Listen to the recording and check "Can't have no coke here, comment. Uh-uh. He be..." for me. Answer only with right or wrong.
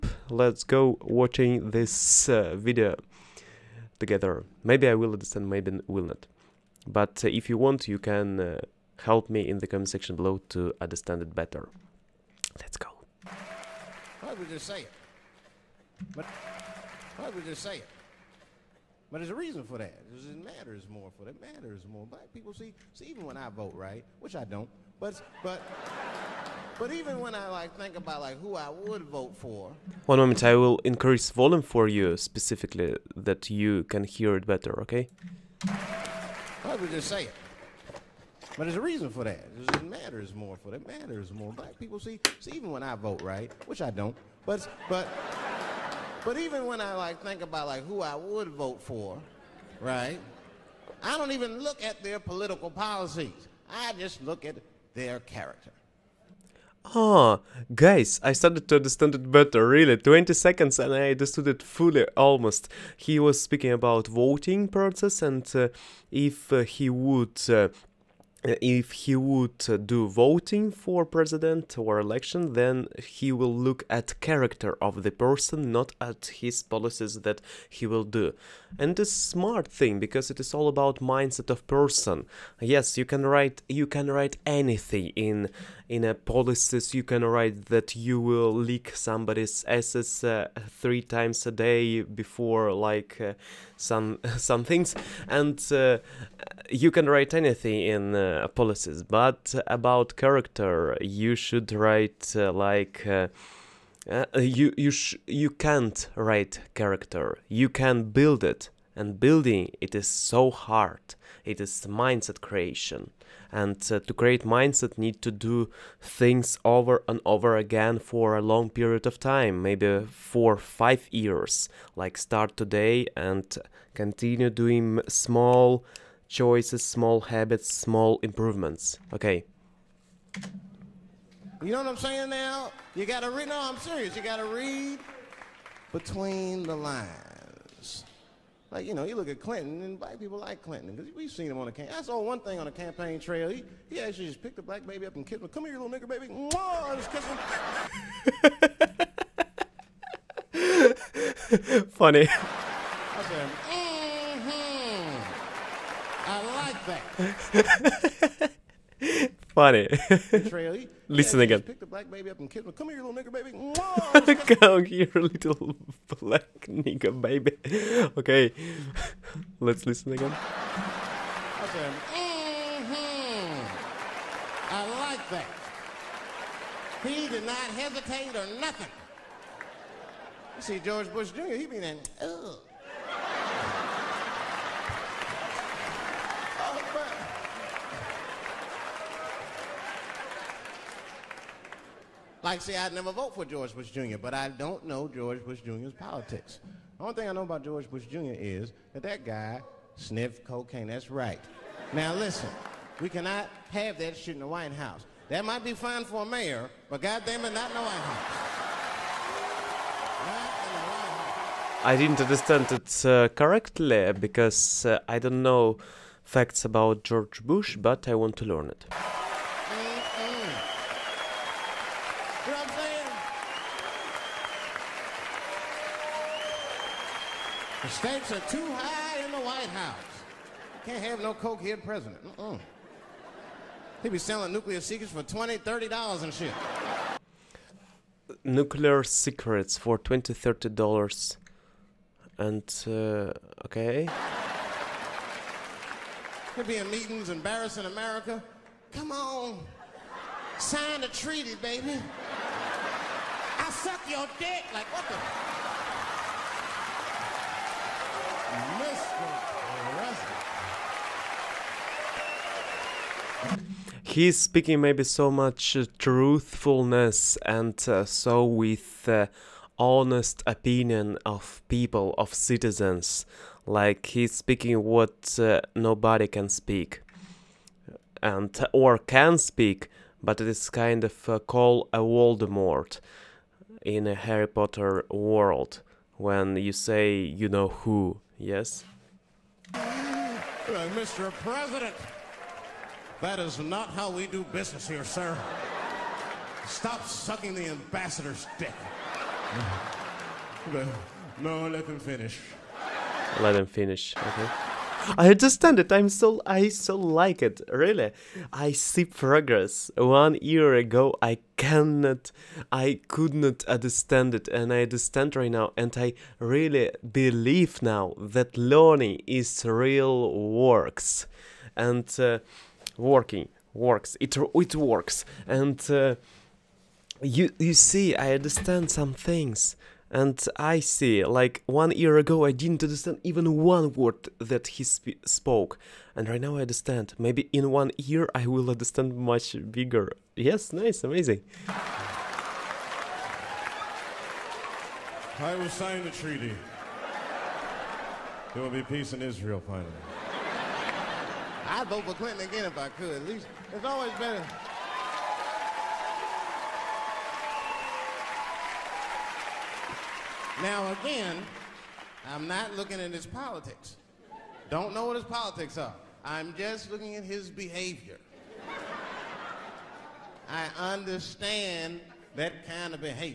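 wrong.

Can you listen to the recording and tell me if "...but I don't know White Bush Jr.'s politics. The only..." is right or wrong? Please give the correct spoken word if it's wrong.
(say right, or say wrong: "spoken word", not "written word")
wrong: "George", not "White".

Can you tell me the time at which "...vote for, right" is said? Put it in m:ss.
0:48.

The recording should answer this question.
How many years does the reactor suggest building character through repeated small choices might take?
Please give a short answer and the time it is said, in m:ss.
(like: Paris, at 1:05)
5, at 2:00.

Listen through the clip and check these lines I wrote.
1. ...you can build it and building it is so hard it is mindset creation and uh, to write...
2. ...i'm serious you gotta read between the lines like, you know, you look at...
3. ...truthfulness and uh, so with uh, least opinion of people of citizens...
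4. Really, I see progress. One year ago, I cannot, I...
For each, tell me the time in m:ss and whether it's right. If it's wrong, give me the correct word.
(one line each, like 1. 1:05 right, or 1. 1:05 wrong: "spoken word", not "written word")
1. 1:47 wrong: "create", not "write"
2. 2:13 right
3. 4:25 wrong: "honest", not "least"
4. 5:07 right.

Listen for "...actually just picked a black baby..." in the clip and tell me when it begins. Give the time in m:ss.
2:23.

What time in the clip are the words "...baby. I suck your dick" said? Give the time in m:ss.
4:11.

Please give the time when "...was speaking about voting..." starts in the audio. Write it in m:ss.
1:03.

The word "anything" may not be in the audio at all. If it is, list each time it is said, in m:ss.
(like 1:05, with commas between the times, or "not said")
1:24, 1:37.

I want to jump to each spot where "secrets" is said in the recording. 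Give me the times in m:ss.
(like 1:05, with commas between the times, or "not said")
3:54, 3:59.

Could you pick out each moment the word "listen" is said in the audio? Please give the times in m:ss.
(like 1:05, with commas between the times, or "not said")
2:41, 2:49, 3:22.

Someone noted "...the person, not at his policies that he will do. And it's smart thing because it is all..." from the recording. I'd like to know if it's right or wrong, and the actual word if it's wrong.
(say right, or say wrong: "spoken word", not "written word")
right.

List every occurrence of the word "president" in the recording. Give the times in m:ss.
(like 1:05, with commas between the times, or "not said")
1:11, 3:51, 4:51.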